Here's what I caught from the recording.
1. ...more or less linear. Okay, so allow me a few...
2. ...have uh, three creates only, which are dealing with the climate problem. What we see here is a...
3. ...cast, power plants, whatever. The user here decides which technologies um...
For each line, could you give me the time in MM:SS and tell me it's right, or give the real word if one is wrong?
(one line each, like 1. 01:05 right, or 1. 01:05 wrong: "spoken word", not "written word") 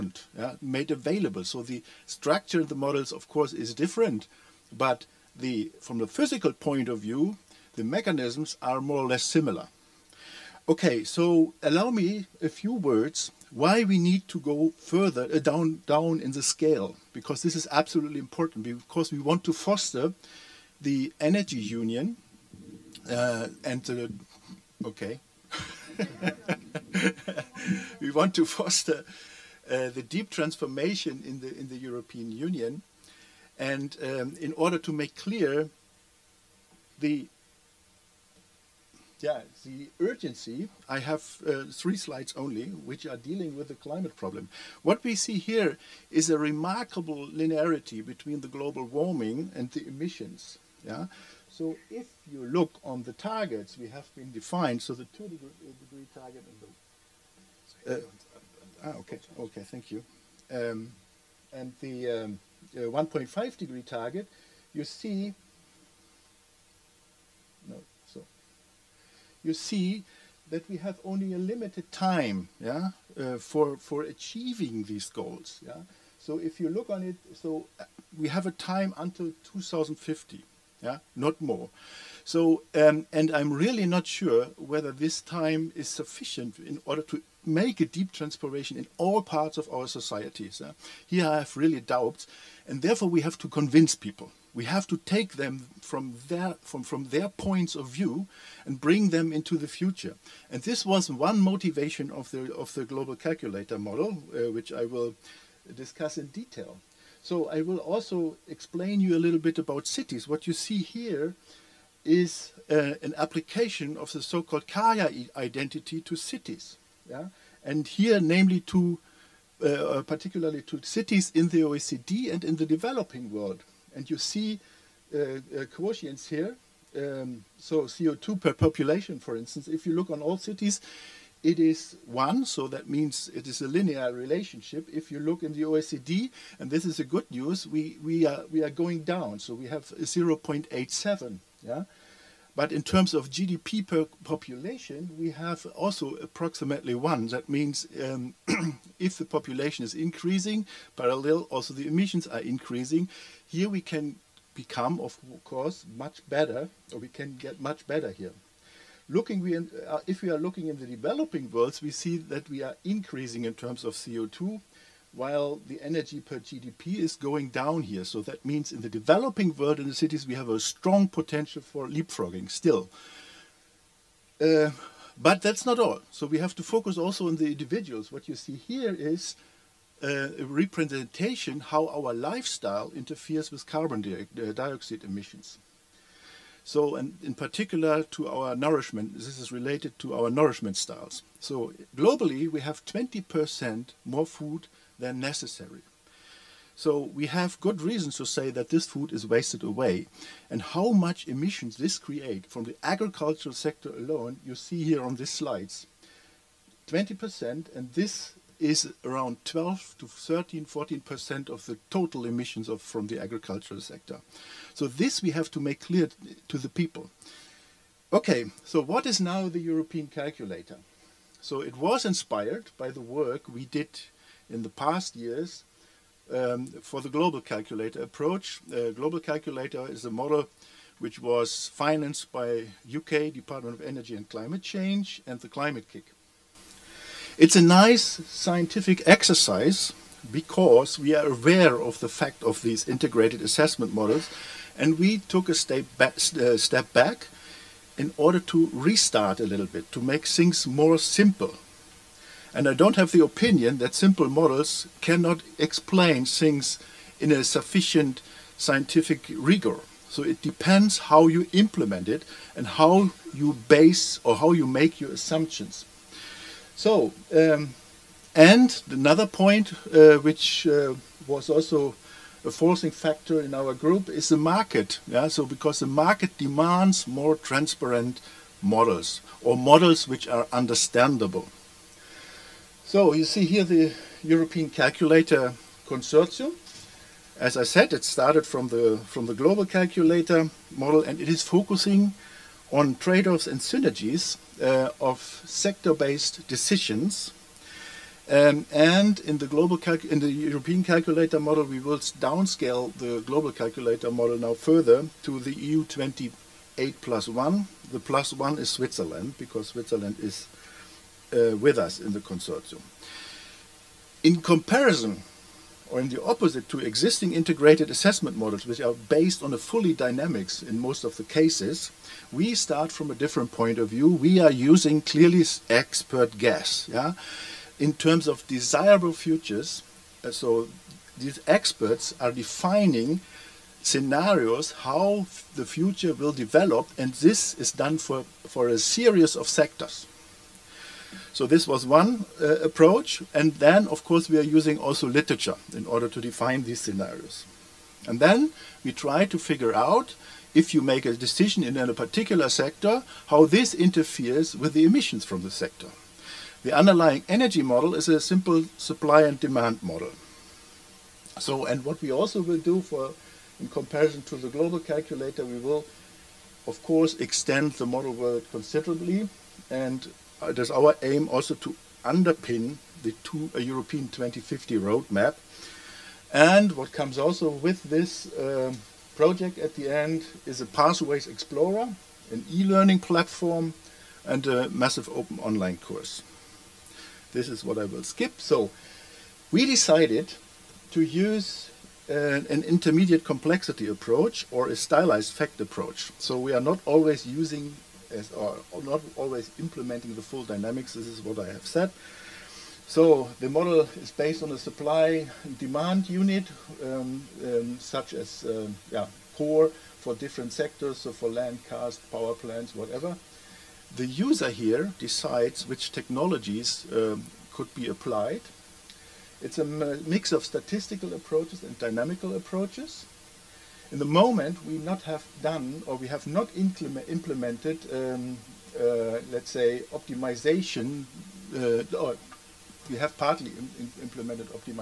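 1. 00:08 wrong: "similar", not "linear"
2. 00:40 wrong: "slides", not "creates"
3. 06:51 right.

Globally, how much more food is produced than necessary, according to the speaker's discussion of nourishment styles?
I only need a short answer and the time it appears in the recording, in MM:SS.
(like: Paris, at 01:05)
20%, at 03:12.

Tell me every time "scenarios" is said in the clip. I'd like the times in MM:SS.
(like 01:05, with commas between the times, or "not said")
05:33, 05:46.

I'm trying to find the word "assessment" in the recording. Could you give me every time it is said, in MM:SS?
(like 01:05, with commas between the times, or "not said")
04:03, 05:17.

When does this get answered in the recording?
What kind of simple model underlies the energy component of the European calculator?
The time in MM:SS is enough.
05:58.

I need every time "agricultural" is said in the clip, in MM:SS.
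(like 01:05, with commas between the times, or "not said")
03:22, 03:33.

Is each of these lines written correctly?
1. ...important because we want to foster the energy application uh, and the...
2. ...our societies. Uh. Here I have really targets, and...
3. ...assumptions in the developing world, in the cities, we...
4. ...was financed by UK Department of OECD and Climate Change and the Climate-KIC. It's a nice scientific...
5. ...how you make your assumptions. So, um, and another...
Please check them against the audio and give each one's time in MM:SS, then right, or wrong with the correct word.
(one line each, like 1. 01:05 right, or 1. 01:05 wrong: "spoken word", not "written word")
1. 00:18 wrong: "union", not "application"
2. 01:29 wrong: "doubts", not "targets"
3. 02:48 wrong: "means", not "assumptions"
4. 03:51 wrong: "Energy", not "OECD"
5. 04:24 right.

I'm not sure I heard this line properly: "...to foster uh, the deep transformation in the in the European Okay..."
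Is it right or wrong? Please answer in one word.
wrong.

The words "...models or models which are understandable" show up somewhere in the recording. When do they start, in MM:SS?
04:38.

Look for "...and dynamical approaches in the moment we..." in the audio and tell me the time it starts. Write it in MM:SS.
07:01.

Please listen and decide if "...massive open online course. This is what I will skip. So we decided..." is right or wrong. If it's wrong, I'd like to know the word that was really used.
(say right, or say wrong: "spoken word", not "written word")
right.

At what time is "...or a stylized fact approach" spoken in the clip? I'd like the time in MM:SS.
06:34.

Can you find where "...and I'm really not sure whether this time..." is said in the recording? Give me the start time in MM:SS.
01:23.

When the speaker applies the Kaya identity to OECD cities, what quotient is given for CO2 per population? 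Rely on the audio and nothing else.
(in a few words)
0.87.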